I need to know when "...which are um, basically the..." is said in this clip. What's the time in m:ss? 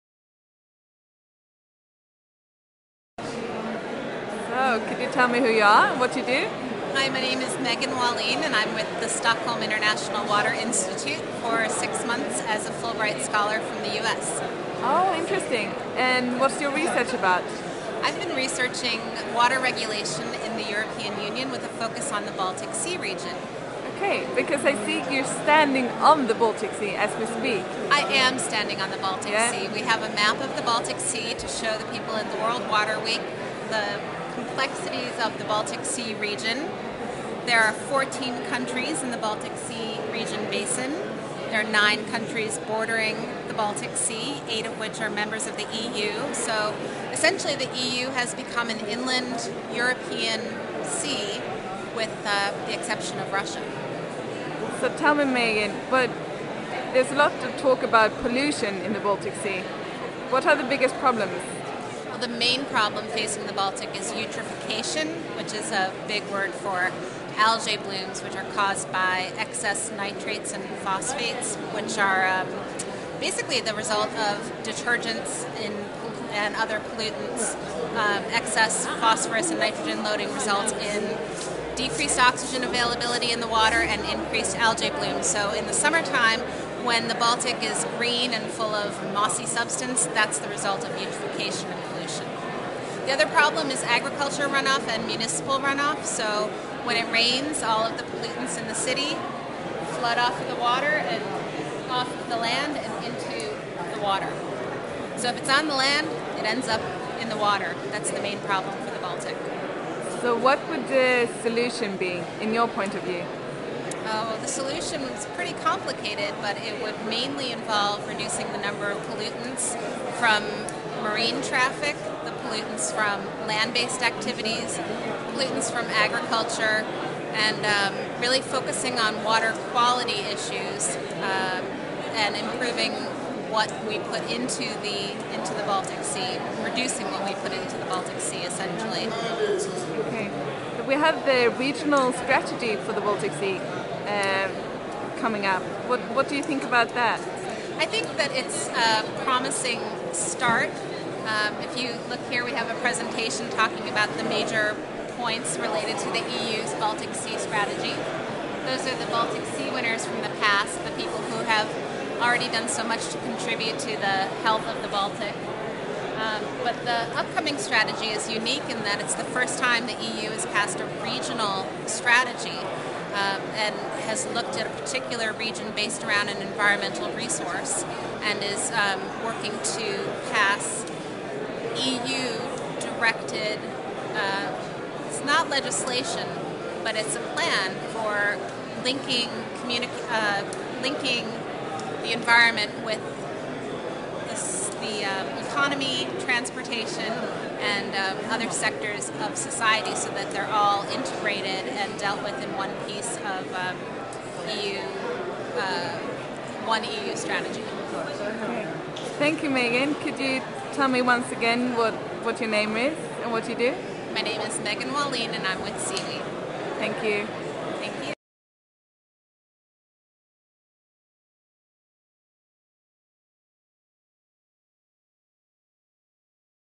1:11.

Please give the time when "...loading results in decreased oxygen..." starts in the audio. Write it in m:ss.
1:20.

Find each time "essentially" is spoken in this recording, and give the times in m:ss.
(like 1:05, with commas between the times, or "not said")
0:47, 2:18.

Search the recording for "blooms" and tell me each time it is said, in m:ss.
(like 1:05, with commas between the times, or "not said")
1:07, 1:24.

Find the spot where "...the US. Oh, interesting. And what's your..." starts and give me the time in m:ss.
0:13.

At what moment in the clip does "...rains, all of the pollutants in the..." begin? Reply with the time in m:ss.
1:37.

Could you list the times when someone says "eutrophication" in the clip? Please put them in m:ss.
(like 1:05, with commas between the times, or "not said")
1:04, 1:30.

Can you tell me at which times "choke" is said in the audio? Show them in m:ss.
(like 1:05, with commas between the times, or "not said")
not said.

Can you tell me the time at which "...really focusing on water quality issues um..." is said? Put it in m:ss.
2:08.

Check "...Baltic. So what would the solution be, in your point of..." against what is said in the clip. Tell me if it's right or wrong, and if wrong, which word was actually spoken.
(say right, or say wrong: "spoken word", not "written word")
right.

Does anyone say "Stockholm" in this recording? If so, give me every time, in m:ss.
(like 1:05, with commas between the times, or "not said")
0:09.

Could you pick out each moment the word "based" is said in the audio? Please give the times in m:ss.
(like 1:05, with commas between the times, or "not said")
2:03, 2:55.